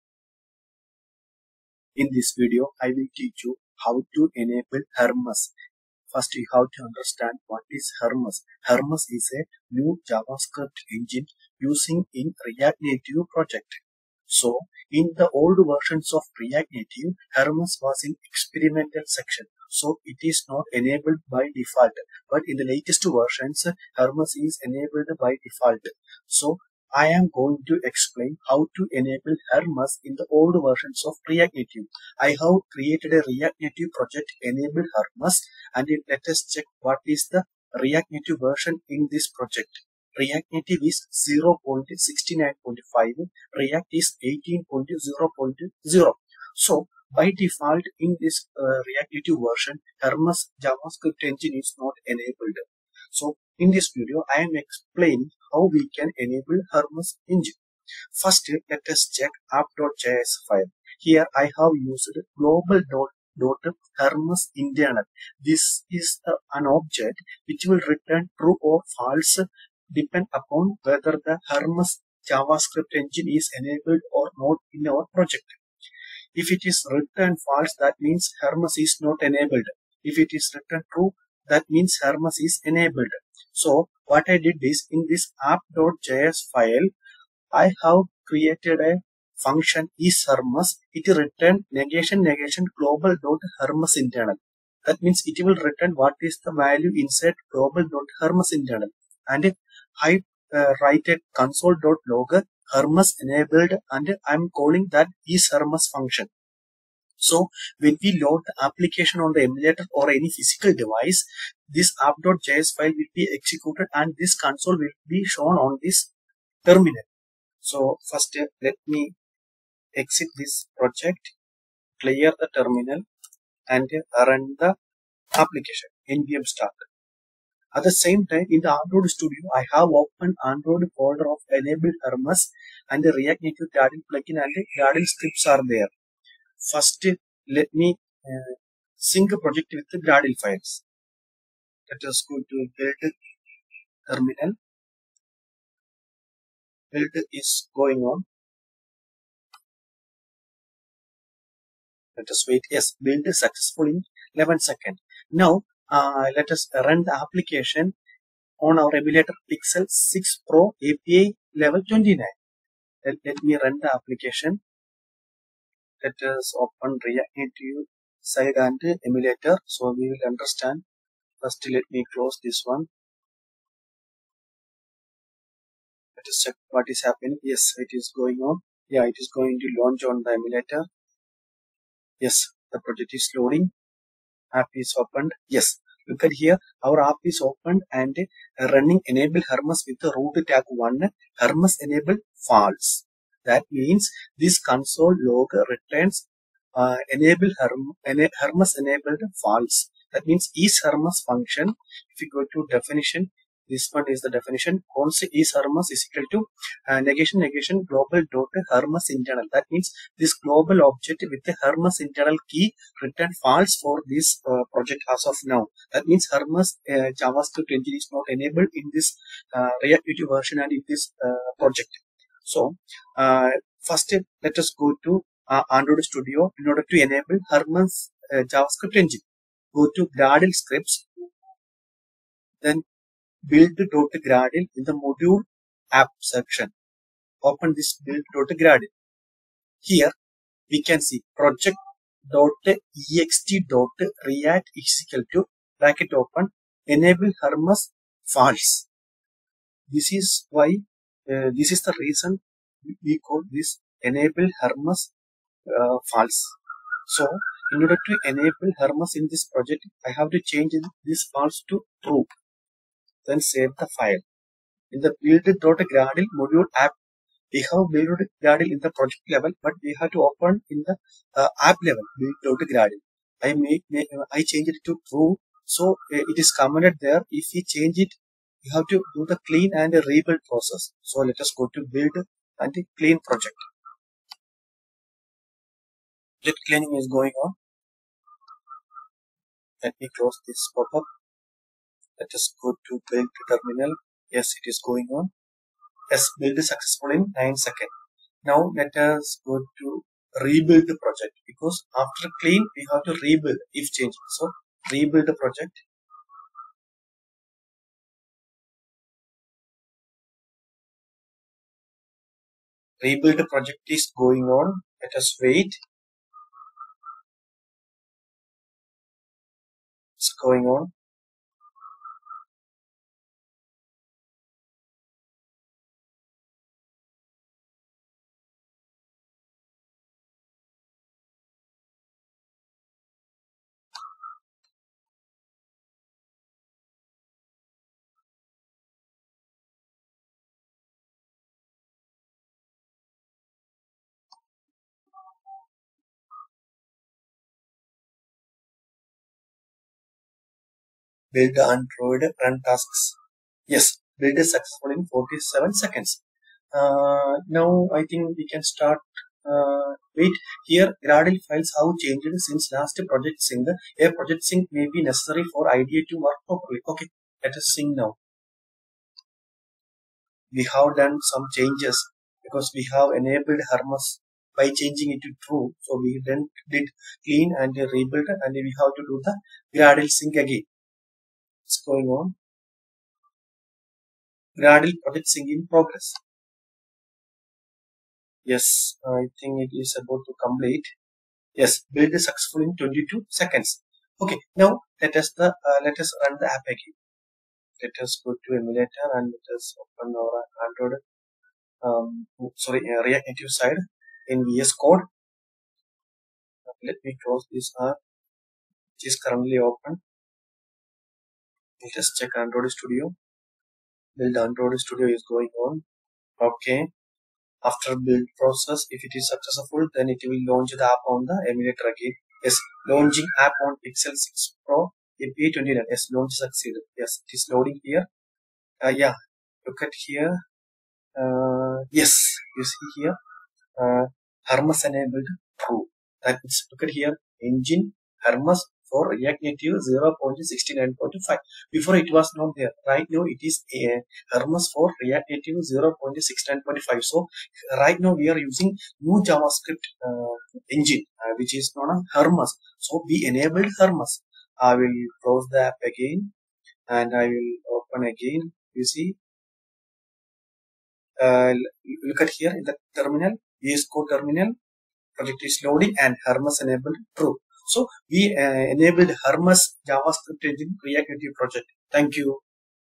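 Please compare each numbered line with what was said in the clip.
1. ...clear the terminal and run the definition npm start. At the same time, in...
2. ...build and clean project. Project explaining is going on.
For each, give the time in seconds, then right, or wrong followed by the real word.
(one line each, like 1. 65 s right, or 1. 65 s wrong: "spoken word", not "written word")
1. 122 s wrong: "application", not "definition"
2. 281 s wrong: "cleaning", not "explaining".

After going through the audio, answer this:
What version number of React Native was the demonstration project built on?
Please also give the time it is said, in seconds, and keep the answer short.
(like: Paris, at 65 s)
0.69.5, at 40 s.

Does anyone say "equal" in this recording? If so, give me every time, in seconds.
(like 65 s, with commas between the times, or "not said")
206 s, 245 s.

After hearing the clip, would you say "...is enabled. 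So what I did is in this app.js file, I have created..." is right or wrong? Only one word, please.
right.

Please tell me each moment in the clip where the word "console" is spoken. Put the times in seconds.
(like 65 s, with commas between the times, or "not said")
101 s, 114 s, 194 s.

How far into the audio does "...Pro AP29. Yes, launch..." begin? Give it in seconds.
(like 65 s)
424 s.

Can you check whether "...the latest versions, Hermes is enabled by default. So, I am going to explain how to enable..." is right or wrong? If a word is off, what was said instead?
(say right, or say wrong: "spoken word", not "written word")
right.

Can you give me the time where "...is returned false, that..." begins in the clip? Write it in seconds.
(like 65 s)
76 s.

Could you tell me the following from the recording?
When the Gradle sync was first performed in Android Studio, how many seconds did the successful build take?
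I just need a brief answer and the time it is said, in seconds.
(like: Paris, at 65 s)
11 seconds, at 154 s.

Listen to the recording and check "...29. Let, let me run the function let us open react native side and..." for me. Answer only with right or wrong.
wrong.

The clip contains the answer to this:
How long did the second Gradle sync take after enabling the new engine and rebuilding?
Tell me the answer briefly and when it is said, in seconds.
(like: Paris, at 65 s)
22 seconds, at 392 s.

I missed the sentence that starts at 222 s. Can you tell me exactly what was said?
So uh, first let us go to uh, Android Studio in order to enable Hermes uh, JavaScript engine.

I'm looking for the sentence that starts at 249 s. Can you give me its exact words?
This is why uh, this is the reason we call this enable Hermes uh, false.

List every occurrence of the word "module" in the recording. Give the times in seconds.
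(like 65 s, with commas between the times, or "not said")
234 s, 266 s.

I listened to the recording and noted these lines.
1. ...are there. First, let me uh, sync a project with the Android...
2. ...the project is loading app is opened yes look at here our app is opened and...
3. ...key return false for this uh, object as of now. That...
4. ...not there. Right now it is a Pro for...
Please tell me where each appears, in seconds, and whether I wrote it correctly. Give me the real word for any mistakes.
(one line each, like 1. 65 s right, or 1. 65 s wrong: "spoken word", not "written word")
1. 135 s wrong: "Gradle", not "Android"
2. 182 s right
3. 212 s wrong: "project", not "object"
4. 442 s wrong: "Hermes", not "Pro".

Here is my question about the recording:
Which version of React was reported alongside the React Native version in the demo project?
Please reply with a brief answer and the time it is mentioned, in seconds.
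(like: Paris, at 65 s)
18.0.0, at 43 s.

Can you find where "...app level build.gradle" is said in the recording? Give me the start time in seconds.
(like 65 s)
271 s.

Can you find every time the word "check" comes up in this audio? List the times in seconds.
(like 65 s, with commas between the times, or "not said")
36 s, 59 s, 176 s, 412 s.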